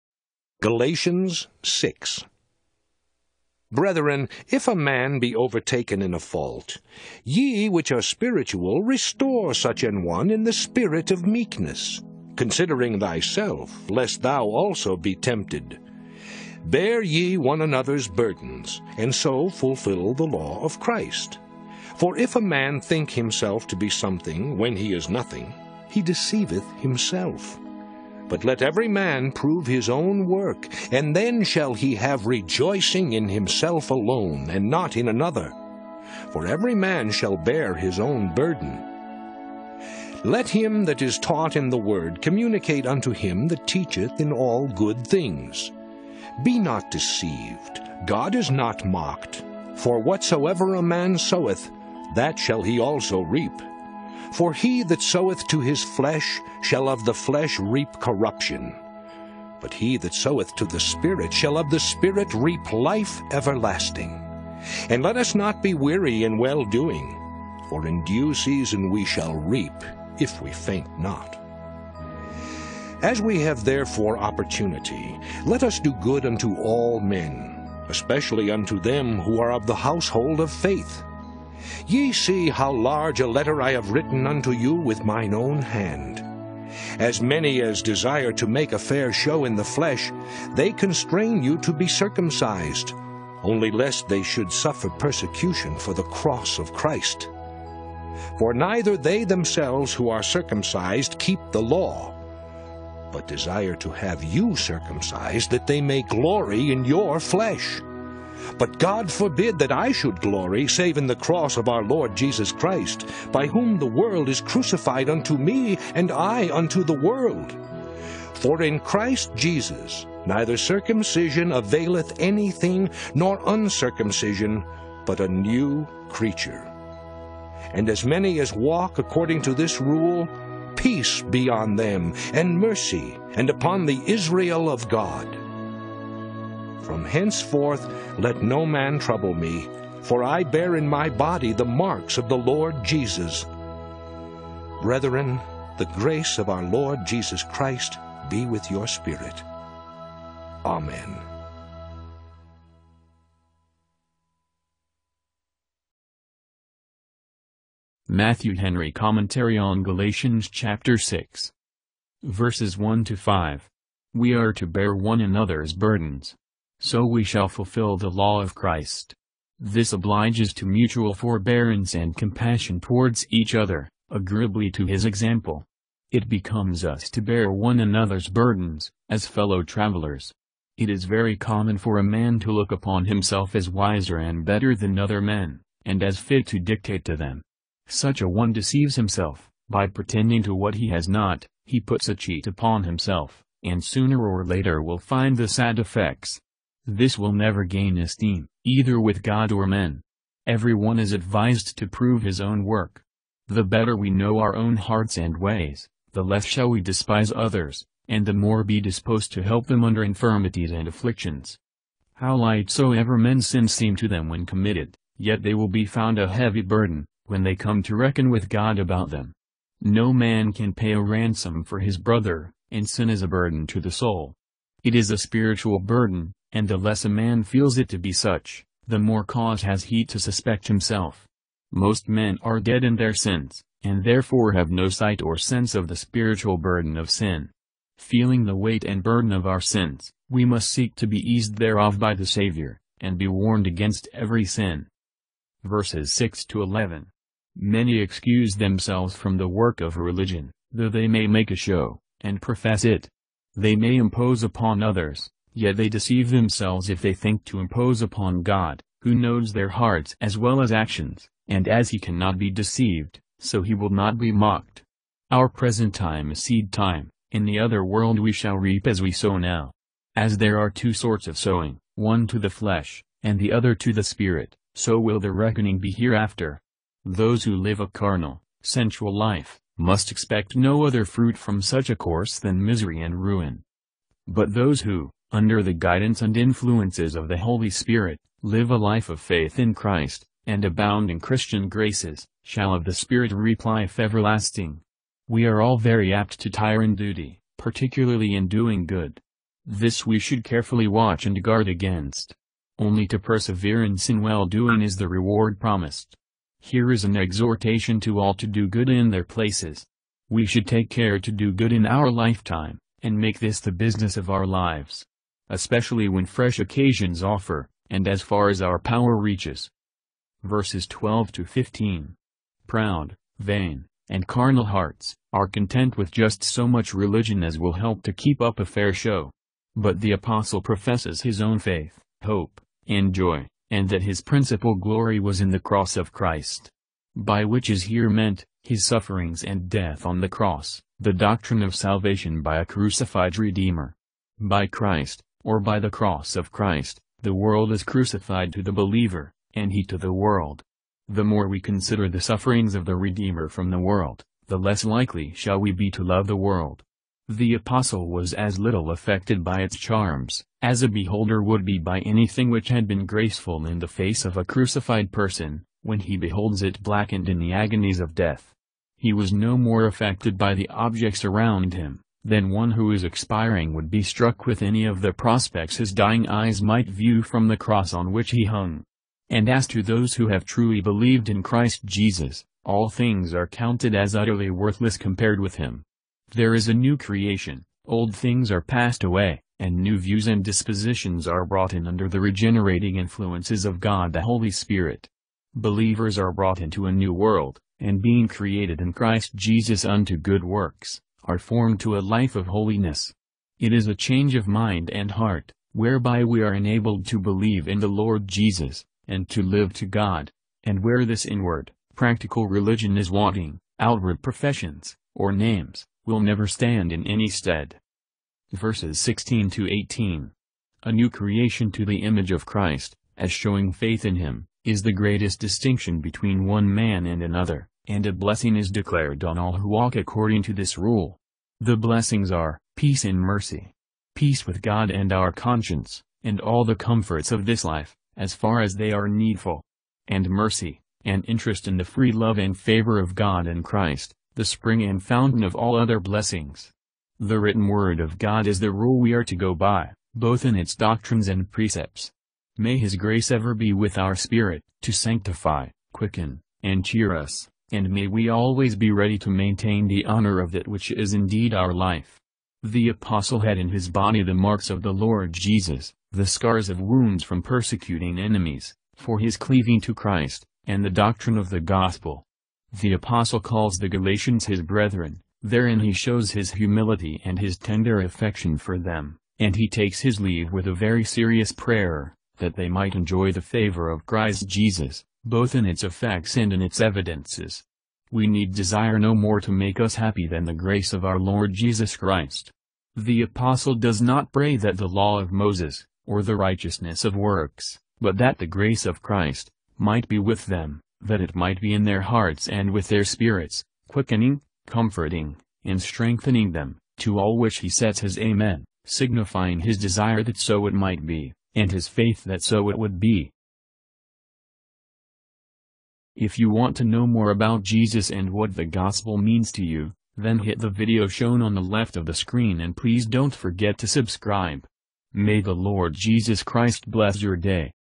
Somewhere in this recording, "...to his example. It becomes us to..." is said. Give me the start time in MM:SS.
02:54.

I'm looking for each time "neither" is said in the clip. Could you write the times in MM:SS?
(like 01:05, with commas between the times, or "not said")
01:38, 02:00.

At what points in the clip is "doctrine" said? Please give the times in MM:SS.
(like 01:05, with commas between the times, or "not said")
05:41, 07:30, 07:50.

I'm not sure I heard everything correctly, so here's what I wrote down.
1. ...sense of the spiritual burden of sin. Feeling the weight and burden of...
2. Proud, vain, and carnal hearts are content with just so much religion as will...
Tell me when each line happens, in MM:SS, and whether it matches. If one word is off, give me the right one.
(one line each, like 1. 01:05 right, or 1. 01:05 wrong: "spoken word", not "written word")
1. 03:55 right
2. 05:22 right.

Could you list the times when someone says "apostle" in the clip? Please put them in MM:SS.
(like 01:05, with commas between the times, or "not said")
05:30, 05:57, 07:42, 07:52, 08:13.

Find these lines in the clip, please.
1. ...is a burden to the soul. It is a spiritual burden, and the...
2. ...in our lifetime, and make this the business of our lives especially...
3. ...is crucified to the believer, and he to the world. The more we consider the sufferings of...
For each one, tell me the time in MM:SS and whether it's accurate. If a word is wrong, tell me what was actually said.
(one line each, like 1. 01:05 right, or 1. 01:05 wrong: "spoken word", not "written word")
1. 03:43 right
2. 05:11 right
3. 05:47 right.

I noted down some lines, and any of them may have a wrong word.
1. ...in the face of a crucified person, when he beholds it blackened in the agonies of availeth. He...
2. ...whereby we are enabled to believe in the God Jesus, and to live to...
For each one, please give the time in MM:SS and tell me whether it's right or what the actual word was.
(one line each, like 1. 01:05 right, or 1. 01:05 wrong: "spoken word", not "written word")
1. 06:03 wrong: "death", not "availeth"
2. 06:45 wrong: "Lord", not "God".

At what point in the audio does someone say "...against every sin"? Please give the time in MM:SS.
04:03.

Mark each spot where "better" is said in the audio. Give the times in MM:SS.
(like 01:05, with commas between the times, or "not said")
03:04, 03:23.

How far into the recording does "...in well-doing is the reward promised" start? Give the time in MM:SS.
05:04.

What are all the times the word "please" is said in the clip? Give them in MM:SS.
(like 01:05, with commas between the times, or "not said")
08:42.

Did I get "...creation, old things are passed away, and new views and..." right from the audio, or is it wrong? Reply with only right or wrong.
right.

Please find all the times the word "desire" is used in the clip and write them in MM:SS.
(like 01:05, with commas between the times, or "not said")
01:27, 01:43, 08:08, 08:29.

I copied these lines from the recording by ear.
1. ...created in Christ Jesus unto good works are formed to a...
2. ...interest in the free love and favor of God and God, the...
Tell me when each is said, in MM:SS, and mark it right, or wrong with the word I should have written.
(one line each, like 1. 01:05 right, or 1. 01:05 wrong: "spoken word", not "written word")
1. 06:38 right
2. 07:21 wrong: "Christ", not "God".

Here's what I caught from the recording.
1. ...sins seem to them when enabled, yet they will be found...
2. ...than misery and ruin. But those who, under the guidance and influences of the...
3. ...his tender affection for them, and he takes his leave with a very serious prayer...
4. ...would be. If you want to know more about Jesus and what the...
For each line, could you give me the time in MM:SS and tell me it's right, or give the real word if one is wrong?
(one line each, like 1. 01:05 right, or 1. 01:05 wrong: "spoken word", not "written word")
1. 03:33 wrong: "committed", not "enabled"
2. 04:42 right
3. 07:57 right
4. 08:32 right.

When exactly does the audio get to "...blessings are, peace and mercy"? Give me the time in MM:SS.
07:11.